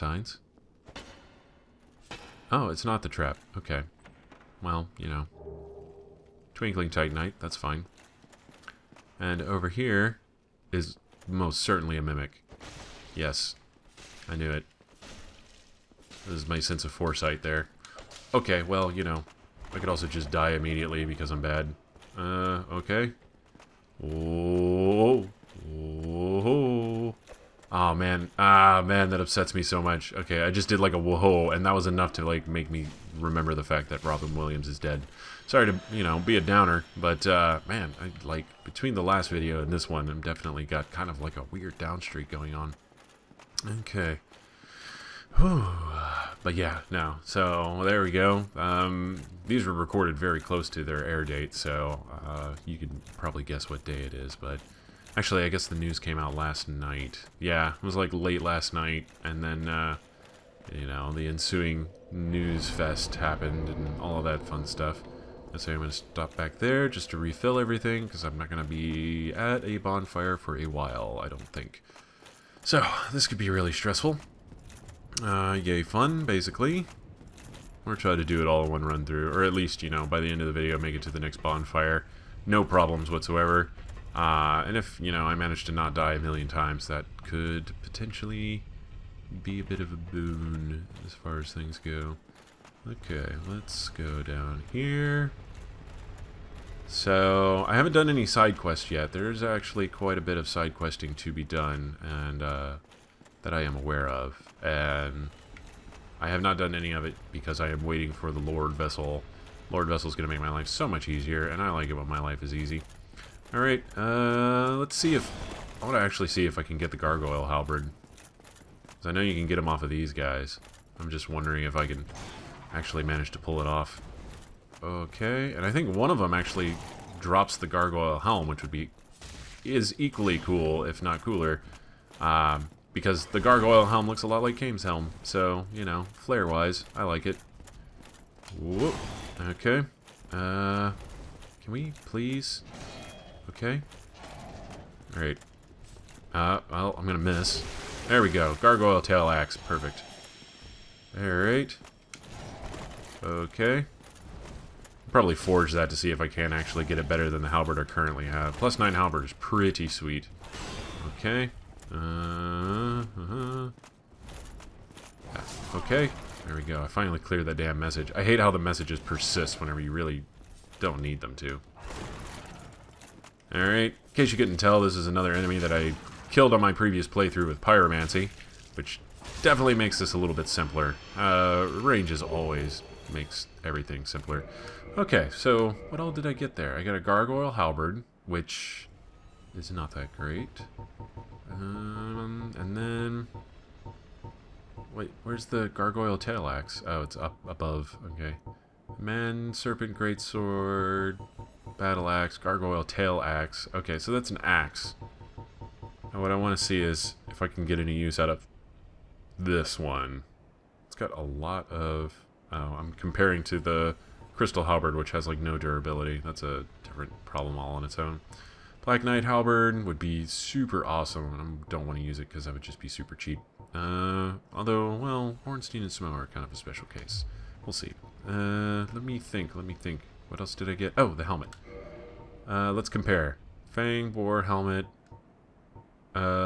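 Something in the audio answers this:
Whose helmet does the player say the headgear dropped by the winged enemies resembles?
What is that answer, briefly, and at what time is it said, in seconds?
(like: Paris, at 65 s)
Kain, at 134 s.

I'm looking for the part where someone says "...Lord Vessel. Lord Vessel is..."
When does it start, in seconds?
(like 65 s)
108 s.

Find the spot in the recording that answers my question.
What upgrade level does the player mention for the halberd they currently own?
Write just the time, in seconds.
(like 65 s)
158 s.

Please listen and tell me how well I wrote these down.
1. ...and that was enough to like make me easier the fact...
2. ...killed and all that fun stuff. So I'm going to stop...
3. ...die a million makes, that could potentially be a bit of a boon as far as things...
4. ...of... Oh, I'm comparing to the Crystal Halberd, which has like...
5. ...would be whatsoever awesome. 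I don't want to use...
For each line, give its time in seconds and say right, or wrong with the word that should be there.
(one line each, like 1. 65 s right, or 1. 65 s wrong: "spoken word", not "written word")
1. 31 s wrong: "remember", not "easier"
2. 63 s wrong: "happened", not "killed"
3. 85 s wrong: "times", not "makes"
4. 211 s right
5. 219 s wrong: "super", not "whatsoever".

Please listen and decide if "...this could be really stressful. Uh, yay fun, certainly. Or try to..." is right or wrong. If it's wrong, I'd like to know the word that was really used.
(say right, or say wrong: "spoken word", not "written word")
wrong: "basically", not "certainly".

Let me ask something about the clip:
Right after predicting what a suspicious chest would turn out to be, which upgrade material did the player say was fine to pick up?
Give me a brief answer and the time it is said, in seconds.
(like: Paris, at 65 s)
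Twinkling Titanite, at 6 s.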